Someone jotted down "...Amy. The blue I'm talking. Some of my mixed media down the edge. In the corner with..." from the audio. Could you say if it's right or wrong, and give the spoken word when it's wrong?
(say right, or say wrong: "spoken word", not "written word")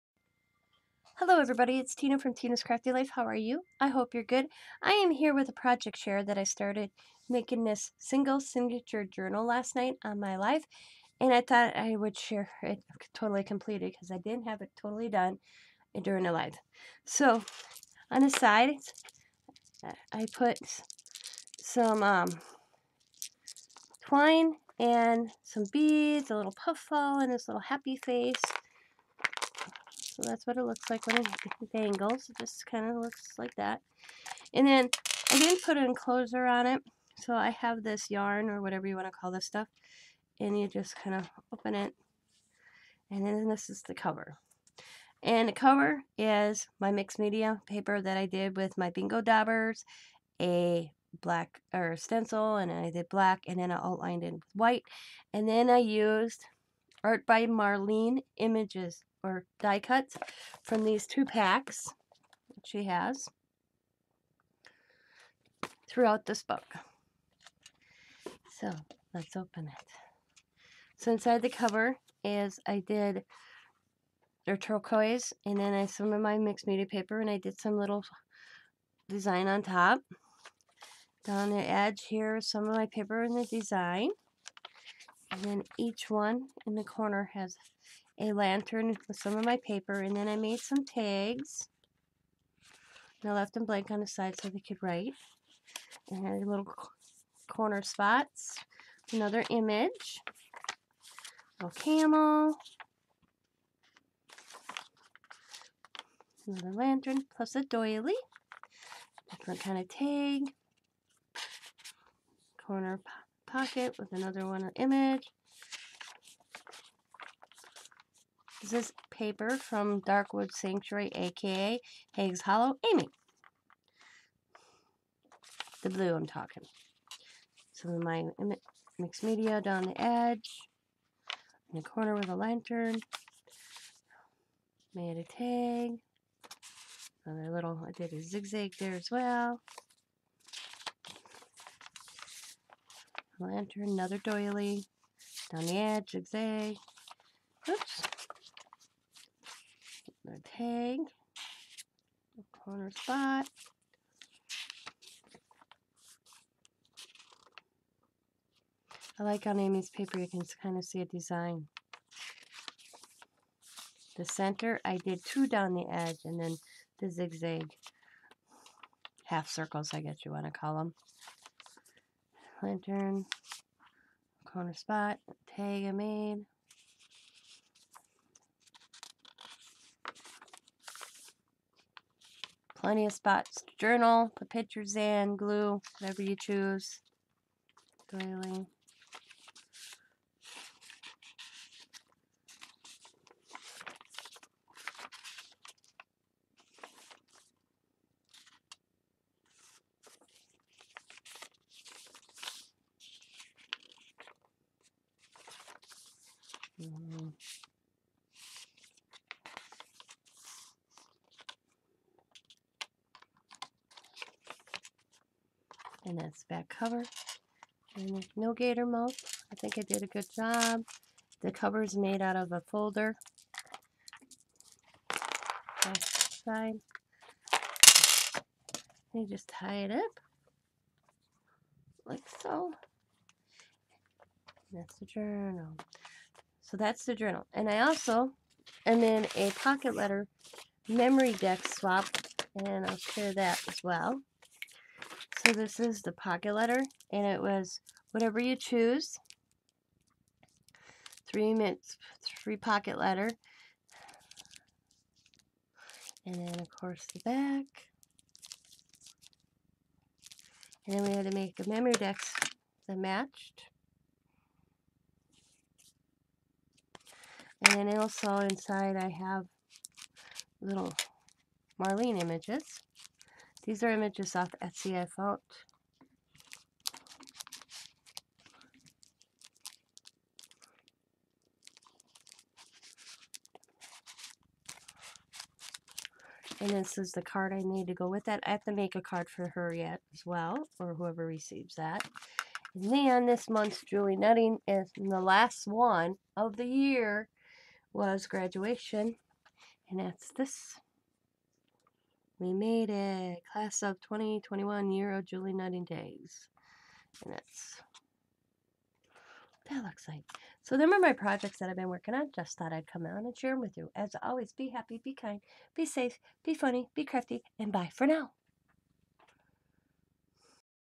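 right.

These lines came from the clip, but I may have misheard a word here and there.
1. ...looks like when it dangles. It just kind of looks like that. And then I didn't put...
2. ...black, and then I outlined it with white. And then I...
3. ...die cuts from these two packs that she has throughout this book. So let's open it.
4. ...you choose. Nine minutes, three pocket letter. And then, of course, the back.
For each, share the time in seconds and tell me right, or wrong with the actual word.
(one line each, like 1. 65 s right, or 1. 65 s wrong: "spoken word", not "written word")
1. 30 s right
2. 53 s right
3. 59 s right
4. 248 s wrong: "Three", not "Nine".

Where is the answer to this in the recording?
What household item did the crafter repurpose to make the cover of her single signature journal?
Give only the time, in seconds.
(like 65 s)
222 s.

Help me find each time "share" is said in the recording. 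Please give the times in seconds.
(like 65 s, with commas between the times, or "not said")
5 s, 12 s, 242 s, 313 s.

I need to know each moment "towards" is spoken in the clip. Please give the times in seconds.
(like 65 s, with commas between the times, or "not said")
not said.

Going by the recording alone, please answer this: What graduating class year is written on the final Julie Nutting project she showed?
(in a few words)
2021.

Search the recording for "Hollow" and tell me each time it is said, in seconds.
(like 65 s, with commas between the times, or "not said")
122 s.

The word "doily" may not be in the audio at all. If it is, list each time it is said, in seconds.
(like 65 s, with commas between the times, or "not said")
107 s, 144 s.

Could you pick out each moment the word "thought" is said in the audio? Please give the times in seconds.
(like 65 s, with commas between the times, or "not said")
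11 s, 275 s, 312 s.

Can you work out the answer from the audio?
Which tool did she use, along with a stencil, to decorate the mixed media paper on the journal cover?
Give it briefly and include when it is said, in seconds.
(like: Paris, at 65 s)
Bingo dabbers, at 48 s.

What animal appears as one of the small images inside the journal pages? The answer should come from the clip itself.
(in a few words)
Camel.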